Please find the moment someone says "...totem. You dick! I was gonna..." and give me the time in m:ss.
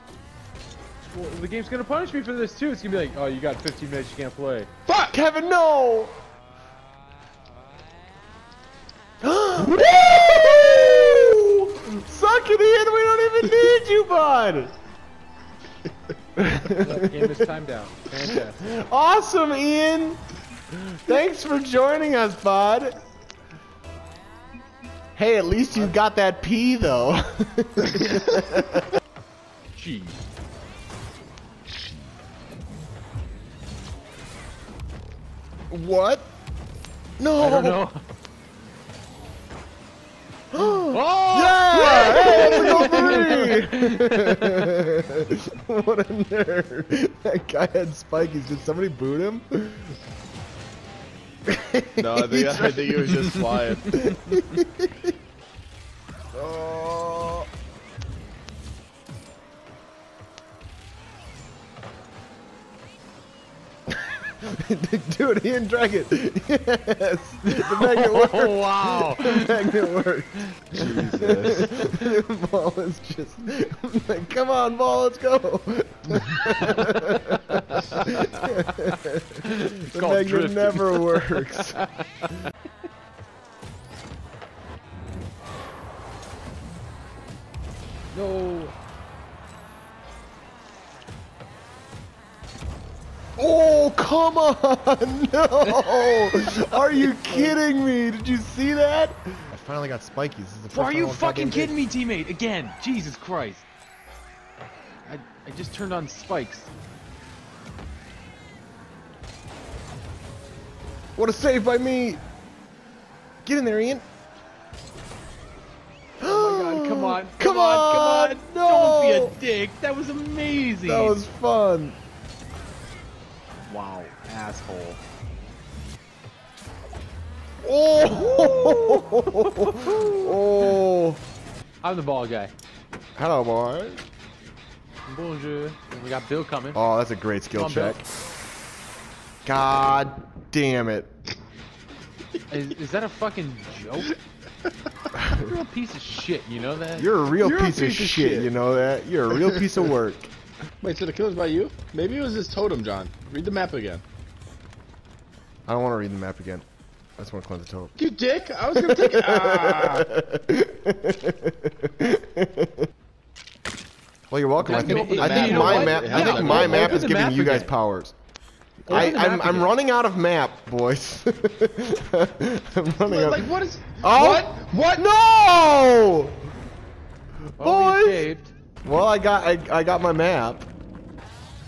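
2:37.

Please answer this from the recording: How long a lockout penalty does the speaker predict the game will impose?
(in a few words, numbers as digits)
15 minutes.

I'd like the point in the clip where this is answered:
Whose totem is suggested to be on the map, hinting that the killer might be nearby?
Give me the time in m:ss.
2:32.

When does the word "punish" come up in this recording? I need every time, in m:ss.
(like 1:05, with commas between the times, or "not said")
0:01.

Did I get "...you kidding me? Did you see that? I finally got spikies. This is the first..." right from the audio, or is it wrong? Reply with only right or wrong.
right.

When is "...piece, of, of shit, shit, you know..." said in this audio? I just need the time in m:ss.
2:27.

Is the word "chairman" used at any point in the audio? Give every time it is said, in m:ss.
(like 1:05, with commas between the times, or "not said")
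not said.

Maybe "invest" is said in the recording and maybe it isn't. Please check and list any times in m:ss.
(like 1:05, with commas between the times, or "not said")
not said.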